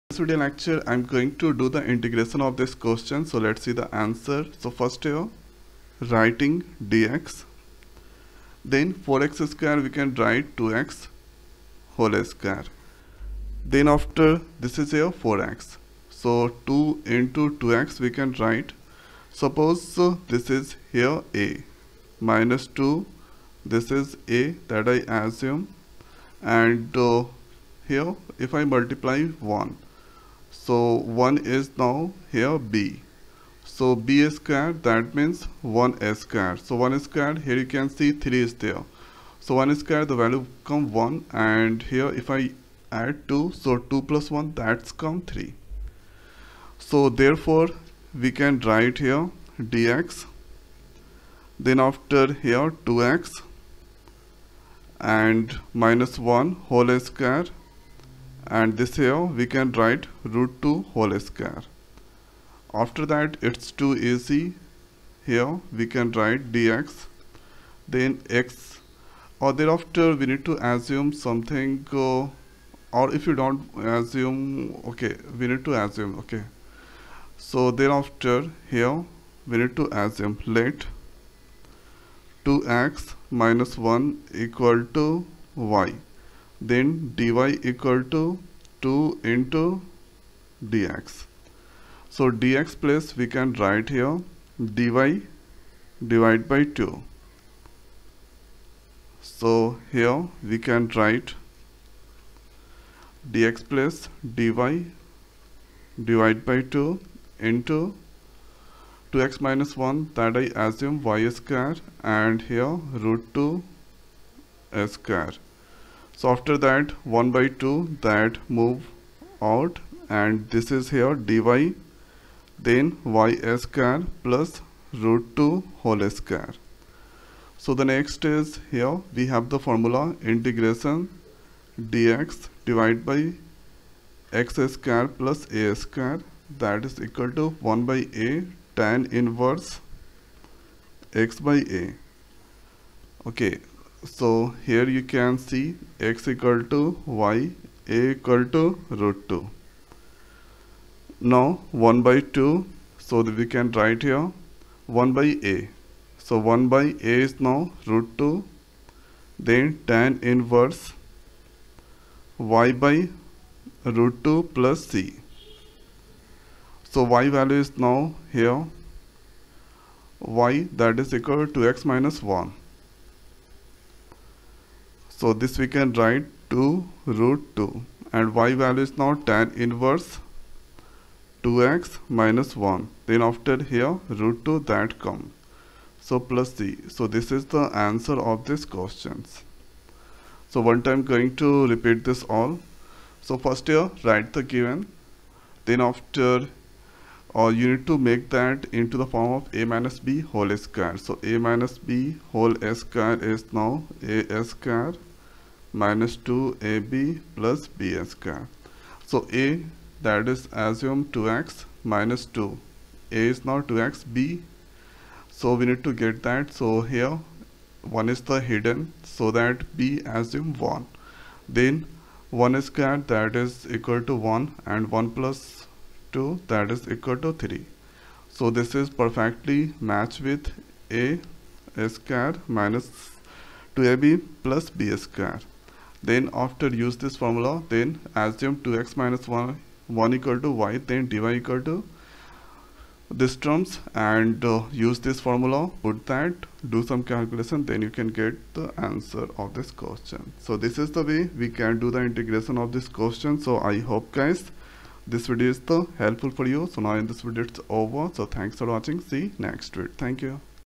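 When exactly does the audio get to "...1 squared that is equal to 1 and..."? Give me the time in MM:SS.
03:42.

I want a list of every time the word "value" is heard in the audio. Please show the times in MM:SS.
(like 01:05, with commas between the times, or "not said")
00:40, 02:47, 02:58.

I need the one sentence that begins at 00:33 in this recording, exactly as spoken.
So B is squared, that means 1 square.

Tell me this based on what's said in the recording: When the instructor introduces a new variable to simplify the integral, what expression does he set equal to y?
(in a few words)
2x minus 1.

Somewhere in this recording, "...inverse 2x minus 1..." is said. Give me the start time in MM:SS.
02:59.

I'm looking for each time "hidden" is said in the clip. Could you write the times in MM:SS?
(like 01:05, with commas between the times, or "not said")
03:38.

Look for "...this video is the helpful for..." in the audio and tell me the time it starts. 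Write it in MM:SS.
04:15.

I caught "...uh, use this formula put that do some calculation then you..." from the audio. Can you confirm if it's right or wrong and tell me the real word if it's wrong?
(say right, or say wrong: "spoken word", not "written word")
right.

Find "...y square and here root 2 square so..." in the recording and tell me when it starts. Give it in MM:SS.
01:51.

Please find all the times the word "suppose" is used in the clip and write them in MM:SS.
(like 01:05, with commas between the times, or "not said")
00:19.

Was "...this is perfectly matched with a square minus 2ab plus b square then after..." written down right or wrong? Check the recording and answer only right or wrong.
right.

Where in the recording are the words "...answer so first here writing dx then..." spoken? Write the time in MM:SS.
00:03.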